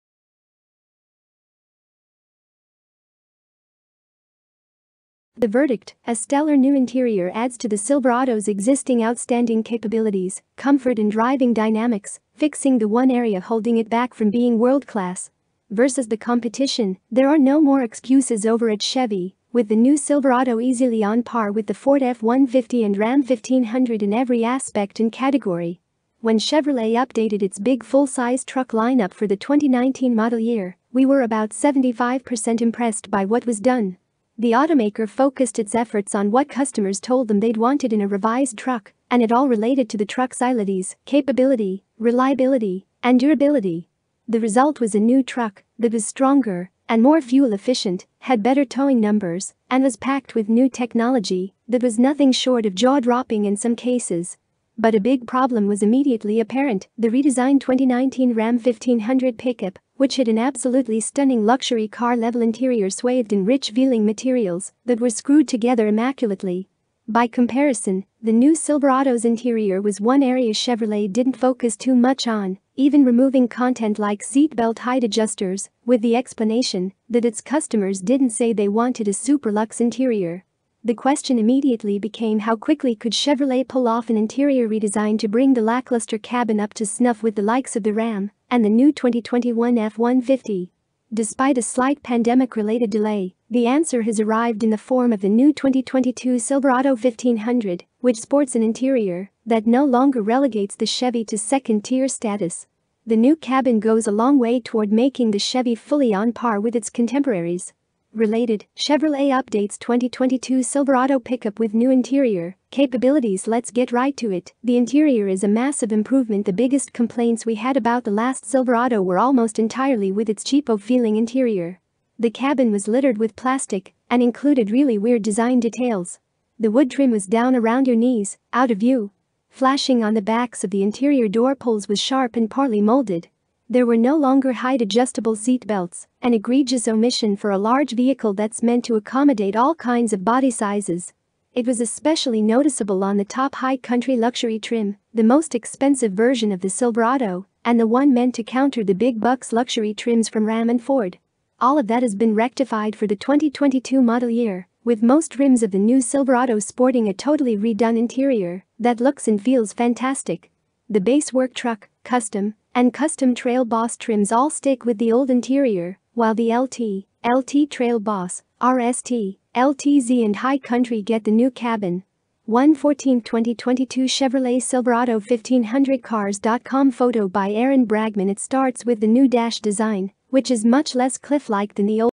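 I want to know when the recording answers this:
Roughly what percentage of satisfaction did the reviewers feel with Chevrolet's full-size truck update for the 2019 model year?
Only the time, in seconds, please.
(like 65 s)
31 s.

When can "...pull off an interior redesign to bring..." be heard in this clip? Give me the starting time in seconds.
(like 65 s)
83 s.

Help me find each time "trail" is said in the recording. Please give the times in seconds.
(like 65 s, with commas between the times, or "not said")
163 s, 167 s.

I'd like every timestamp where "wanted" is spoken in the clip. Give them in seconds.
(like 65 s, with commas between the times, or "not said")
37 s, 78 s.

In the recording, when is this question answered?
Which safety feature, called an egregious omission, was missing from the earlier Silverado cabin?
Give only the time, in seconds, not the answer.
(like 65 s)
134 s.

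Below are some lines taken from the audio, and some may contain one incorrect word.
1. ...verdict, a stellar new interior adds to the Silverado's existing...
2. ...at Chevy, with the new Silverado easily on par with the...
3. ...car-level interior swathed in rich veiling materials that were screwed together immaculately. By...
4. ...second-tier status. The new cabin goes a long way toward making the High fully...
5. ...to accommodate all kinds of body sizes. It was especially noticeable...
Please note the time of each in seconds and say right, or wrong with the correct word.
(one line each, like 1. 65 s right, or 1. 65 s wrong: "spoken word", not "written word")
1. 5 s right
2. 18 s right
3. 61 s right
4. 101 s wrong: "Chevy", not "High"
5. 138 s right.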